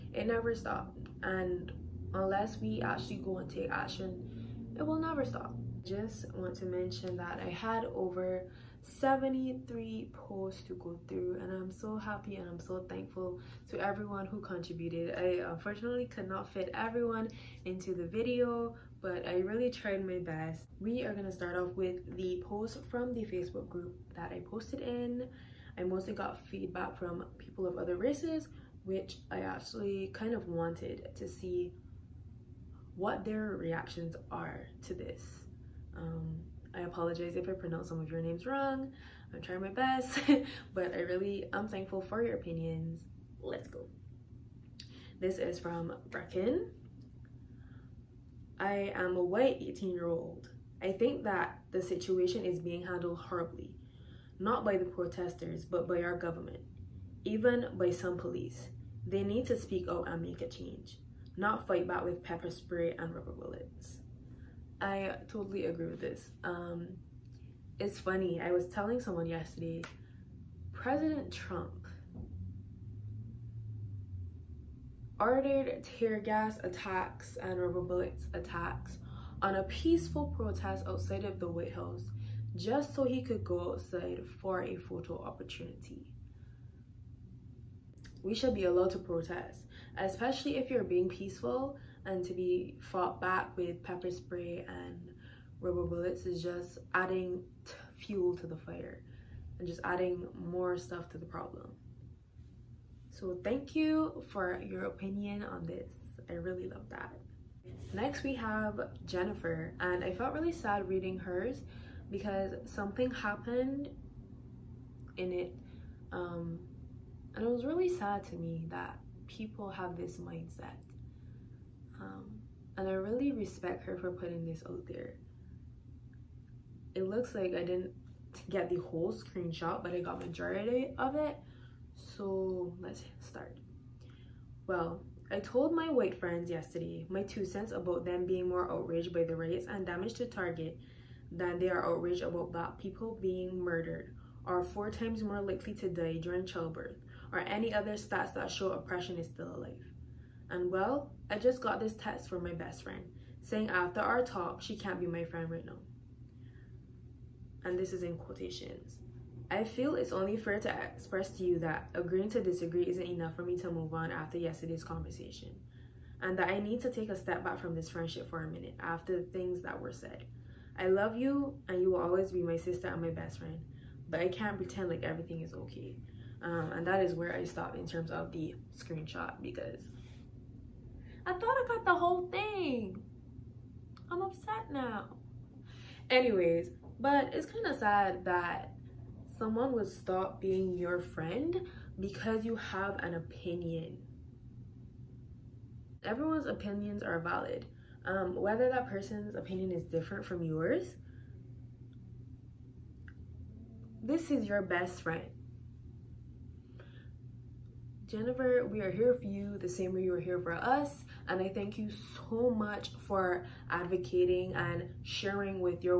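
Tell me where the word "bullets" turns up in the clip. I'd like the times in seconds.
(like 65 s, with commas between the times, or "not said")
63 s, 77 s, 95 s.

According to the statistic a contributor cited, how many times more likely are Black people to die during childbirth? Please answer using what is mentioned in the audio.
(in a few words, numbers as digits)
4.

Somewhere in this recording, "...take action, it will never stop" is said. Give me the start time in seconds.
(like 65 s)
3 s.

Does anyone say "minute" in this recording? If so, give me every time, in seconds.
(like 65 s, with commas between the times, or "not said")
168 s.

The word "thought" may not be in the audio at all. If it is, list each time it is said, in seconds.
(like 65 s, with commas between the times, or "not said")
181 s.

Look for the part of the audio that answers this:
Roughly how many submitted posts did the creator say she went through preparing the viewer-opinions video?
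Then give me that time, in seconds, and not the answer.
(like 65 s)
8 s.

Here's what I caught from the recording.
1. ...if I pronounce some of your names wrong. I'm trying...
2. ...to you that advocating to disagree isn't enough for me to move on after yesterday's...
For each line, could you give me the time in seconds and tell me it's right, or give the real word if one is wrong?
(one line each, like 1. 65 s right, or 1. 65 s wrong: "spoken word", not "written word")
1. 37 s right
2. 161 s wrong: "agreeing", not "advocating".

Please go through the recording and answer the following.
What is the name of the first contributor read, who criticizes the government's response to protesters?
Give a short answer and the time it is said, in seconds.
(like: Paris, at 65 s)
Brecken, at 46 s.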